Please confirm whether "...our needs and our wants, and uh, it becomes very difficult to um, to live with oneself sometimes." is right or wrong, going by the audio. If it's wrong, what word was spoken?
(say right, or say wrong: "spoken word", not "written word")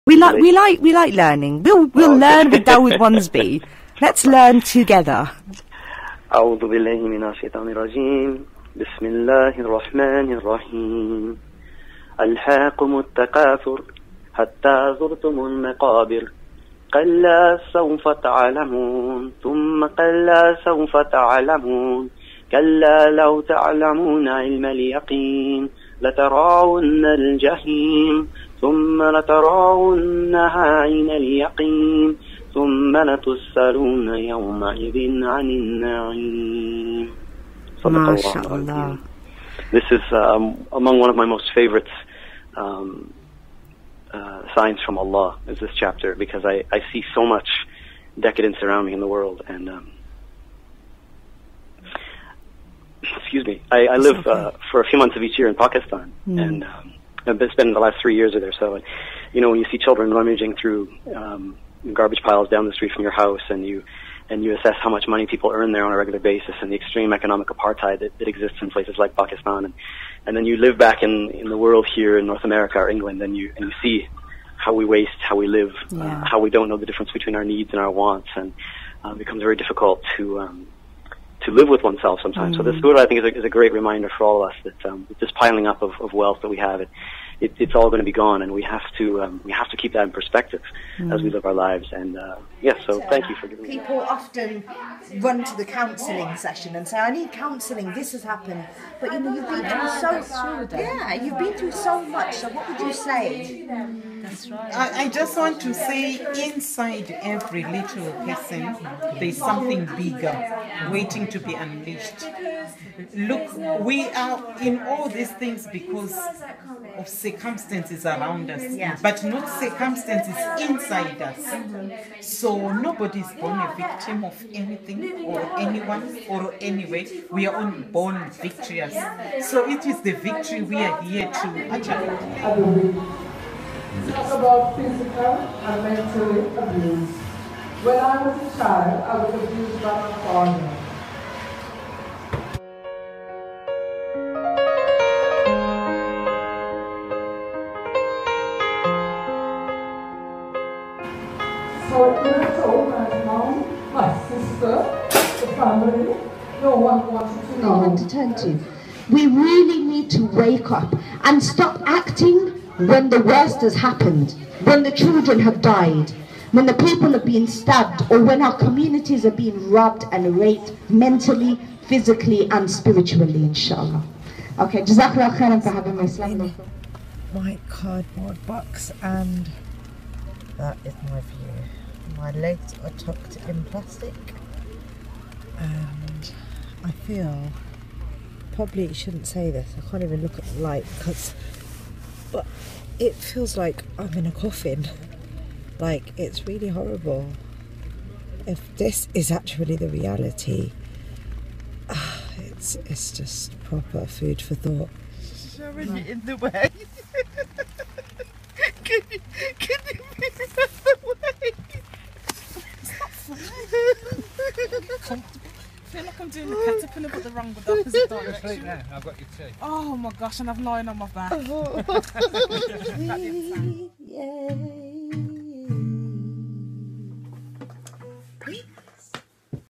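right.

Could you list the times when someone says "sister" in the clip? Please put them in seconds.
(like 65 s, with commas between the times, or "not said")
154 s.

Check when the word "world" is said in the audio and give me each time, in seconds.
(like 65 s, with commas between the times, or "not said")
49 s, 71 s.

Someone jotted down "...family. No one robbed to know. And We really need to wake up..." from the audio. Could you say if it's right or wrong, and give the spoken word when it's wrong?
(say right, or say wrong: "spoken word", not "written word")
wrong: "wanted", not "robbed".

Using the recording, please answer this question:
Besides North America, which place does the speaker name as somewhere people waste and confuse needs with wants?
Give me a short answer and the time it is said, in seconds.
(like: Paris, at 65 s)
England, at 72 s.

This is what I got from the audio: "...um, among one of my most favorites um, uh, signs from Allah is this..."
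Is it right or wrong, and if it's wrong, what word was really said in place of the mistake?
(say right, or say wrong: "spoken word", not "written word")
right.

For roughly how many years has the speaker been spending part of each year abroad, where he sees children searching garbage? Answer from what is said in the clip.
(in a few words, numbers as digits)
3 years.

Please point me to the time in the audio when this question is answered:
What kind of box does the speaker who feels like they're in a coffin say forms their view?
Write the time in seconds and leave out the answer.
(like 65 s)
177 s.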